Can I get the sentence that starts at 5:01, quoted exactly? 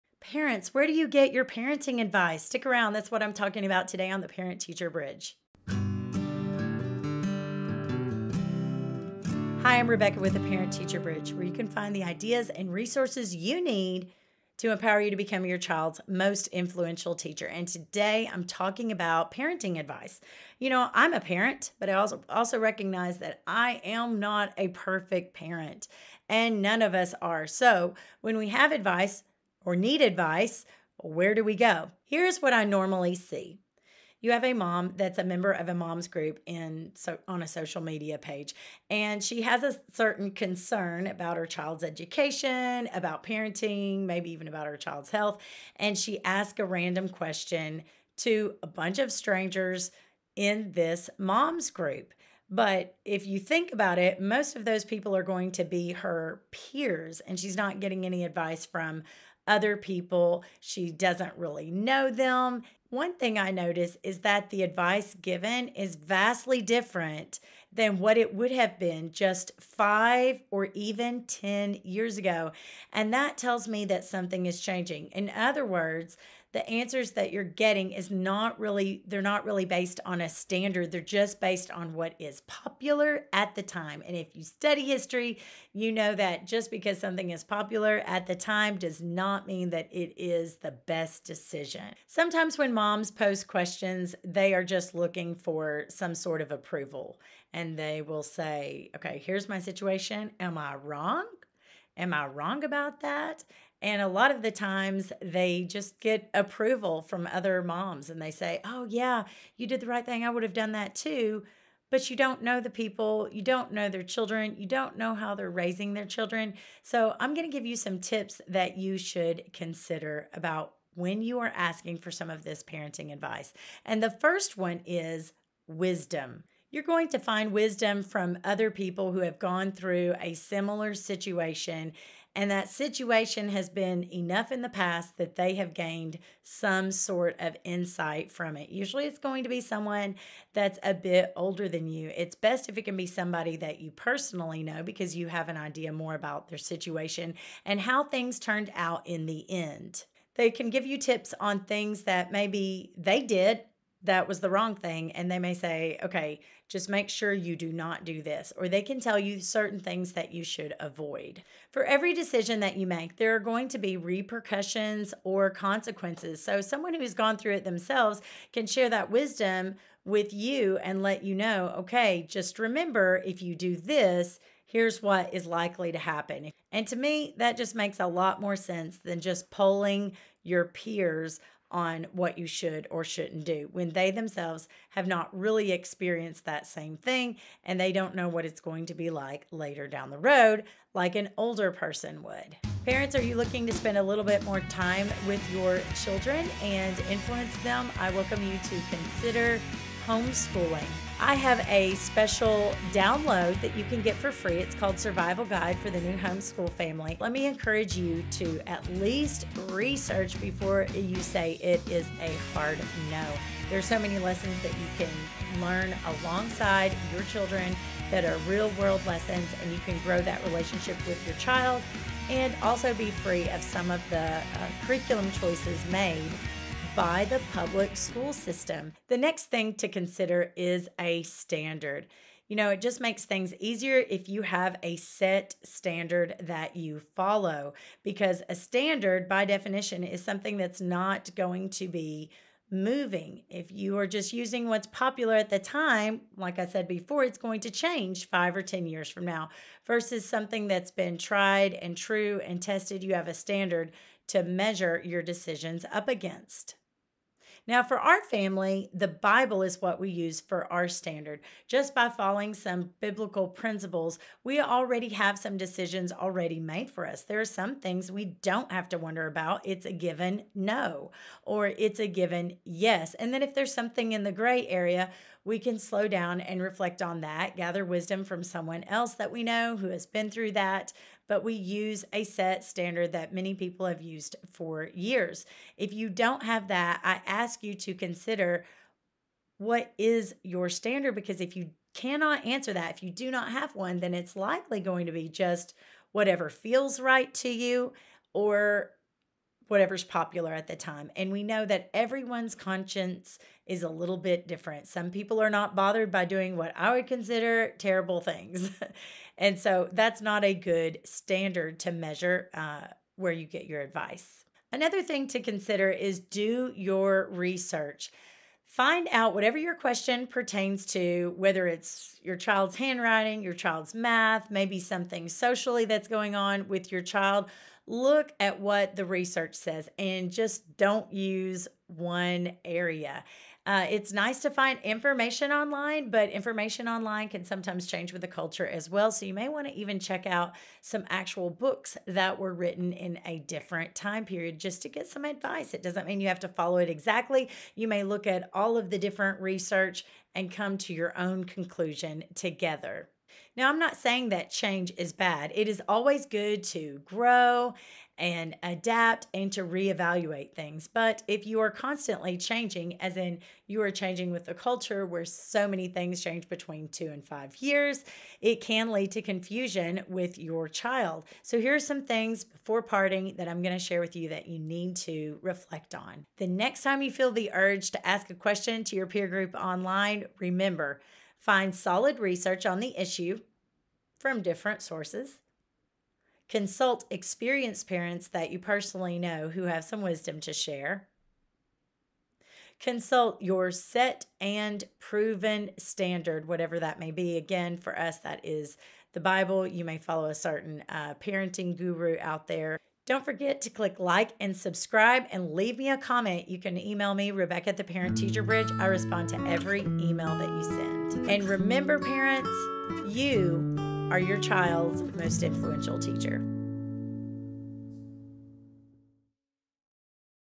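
And we know that everyone's conscience is a little bit different.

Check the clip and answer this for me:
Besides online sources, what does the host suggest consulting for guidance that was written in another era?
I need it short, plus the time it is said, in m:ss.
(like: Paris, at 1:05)
Actual books, at 5:41.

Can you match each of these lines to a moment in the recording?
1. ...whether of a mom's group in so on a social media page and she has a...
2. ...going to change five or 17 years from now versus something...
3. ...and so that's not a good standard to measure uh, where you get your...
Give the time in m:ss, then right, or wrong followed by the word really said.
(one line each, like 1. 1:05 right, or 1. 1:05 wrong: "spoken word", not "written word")
1. 0:35 wrong: "member", not "whether"
2. 4:07 wrong: "10", not "17"
3. 5:09 right.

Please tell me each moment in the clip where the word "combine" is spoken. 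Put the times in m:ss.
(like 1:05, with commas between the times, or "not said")
not said.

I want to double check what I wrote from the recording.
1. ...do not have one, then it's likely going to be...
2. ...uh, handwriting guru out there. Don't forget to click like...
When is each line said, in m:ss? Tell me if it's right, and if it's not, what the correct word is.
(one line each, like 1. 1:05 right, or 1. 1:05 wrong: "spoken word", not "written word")
1. 4:53 right
2. 6:40 wrong: "parenting", not "handwriting".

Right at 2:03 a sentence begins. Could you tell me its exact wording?
And the first one is wisdom.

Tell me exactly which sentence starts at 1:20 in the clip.
They're just based on what is popular at the time.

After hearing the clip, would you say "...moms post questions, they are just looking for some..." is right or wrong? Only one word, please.
right.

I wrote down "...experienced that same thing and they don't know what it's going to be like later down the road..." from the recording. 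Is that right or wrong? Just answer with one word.
right.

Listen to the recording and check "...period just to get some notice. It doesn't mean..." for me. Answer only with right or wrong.
wrong.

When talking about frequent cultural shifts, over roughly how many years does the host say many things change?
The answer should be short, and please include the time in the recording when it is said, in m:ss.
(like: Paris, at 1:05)
Between 2 and 5 years, at 6:06.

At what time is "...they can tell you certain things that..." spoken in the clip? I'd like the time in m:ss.
2:38.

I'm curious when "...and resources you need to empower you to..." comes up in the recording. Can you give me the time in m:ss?
0:12.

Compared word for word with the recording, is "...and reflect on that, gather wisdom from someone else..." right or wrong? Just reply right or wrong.
right.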